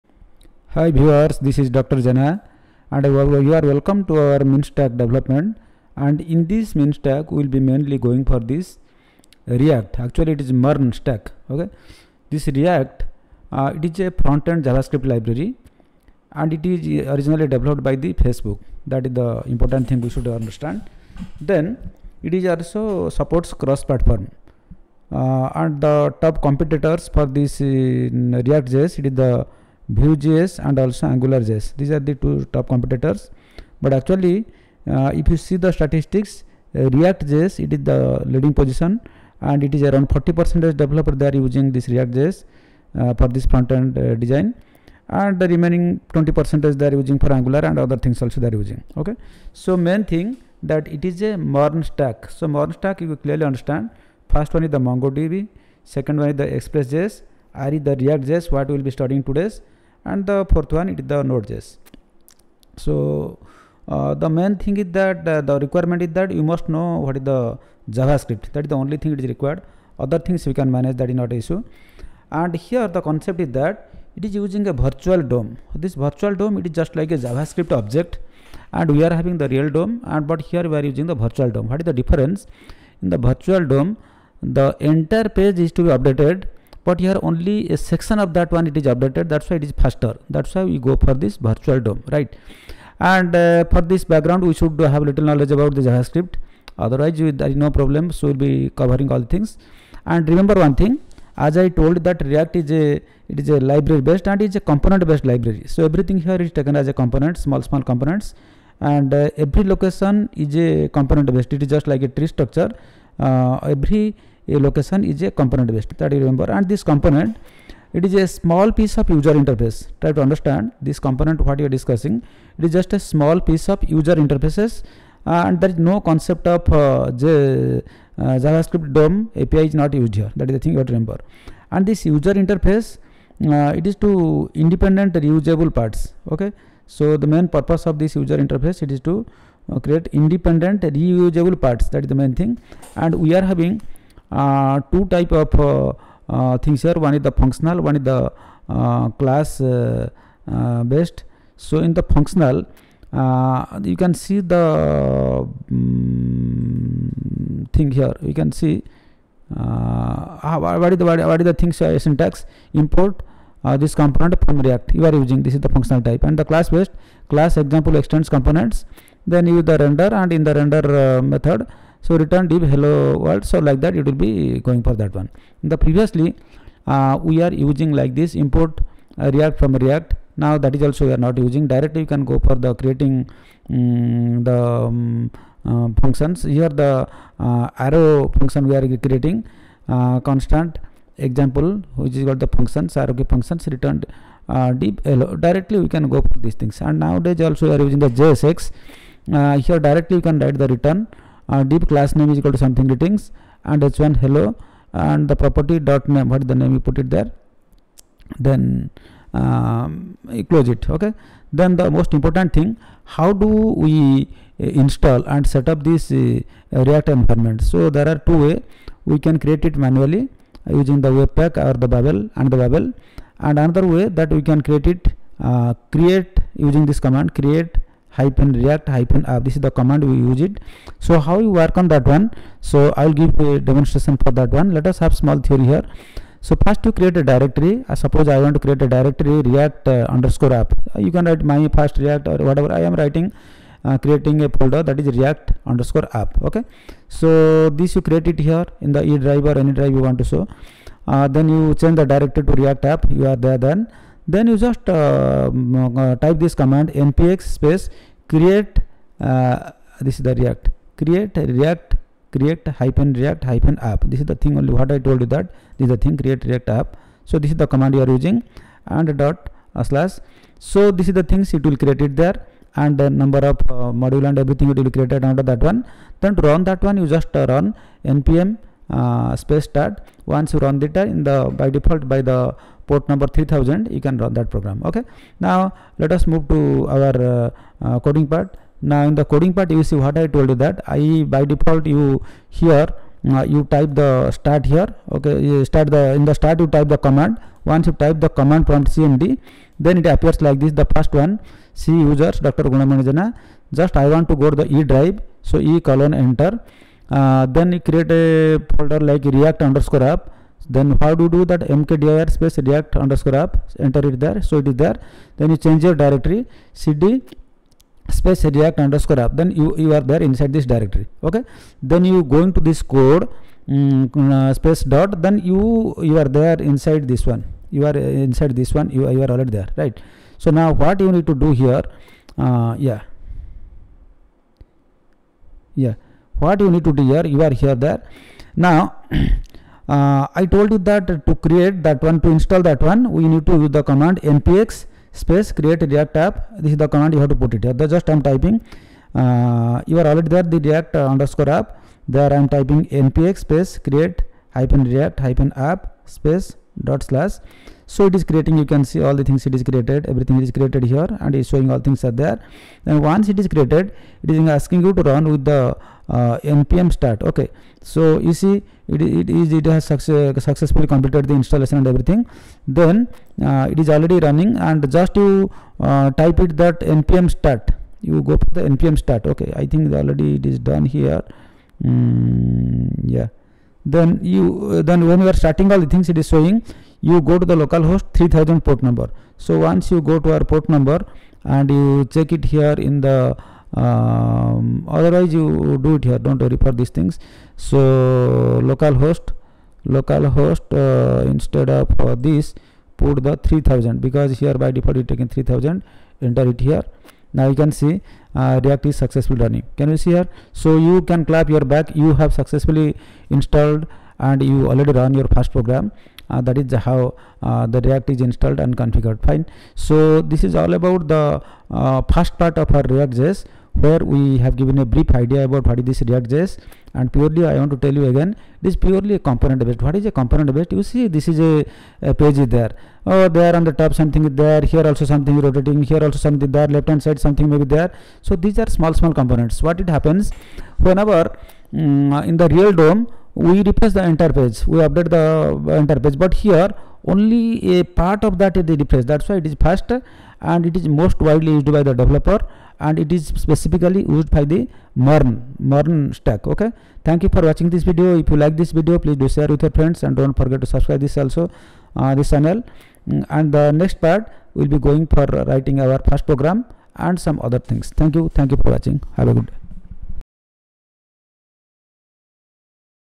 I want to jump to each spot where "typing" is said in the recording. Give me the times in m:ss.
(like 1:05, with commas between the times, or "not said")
5:48, 5:52.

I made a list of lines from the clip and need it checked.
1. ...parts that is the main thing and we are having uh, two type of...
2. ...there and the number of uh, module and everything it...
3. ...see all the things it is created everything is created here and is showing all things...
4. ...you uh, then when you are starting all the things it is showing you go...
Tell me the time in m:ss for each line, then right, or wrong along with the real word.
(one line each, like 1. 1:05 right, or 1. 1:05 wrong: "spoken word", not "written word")
1. 2:21 right
2. 4:32 right
3. 5:58 right
4. 6:24 right.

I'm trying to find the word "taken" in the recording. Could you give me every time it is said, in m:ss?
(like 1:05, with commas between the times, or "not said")
1:46.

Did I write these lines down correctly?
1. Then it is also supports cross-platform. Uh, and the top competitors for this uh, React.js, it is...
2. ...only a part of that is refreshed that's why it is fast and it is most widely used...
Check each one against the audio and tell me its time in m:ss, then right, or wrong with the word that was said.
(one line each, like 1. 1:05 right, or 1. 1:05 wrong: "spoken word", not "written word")
1. 0:21 right
2. 7:27 right.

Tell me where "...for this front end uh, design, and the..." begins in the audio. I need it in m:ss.
0:43.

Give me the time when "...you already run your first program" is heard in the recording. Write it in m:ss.
6:54.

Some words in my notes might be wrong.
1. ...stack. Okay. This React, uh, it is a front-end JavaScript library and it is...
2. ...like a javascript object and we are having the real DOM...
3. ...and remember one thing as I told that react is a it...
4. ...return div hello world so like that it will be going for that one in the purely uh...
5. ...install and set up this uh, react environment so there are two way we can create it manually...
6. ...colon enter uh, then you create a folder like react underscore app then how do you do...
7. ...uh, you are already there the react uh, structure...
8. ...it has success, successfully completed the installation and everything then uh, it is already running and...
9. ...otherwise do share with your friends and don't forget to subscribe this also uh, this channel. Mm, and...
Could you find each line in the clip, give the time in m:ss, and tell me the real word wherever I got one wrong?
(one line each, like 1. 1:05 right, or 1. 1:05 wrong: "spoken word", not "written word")
1. 0:10 right
2. 1:16 right
3. 1:40 right
4. 2:52 wrong: "previously", not "purely"
5. 3:34 right
6. 5:05 right
7. 5:49 wrong: "underscore", not "structure"
8. 6:09 right
9. 7:38 wrong: "please", not "otherwise".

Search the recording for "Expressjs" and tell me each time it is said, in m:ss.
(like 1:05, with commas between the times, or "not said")
0:56.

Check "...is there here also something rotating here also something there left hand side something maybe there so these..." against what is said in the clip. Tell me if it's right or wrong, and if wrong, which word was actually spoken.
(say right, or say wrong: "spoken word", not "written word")
right.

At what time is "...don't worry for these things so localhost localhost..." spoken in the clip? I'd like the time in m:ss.
6:36.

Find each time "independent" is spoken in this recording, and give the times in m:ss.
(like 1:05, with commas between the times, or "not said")
2:14, 2:20.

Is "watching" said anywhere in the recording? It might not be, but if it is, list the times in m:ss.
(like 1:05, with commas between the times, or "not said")
7:37, 7:48.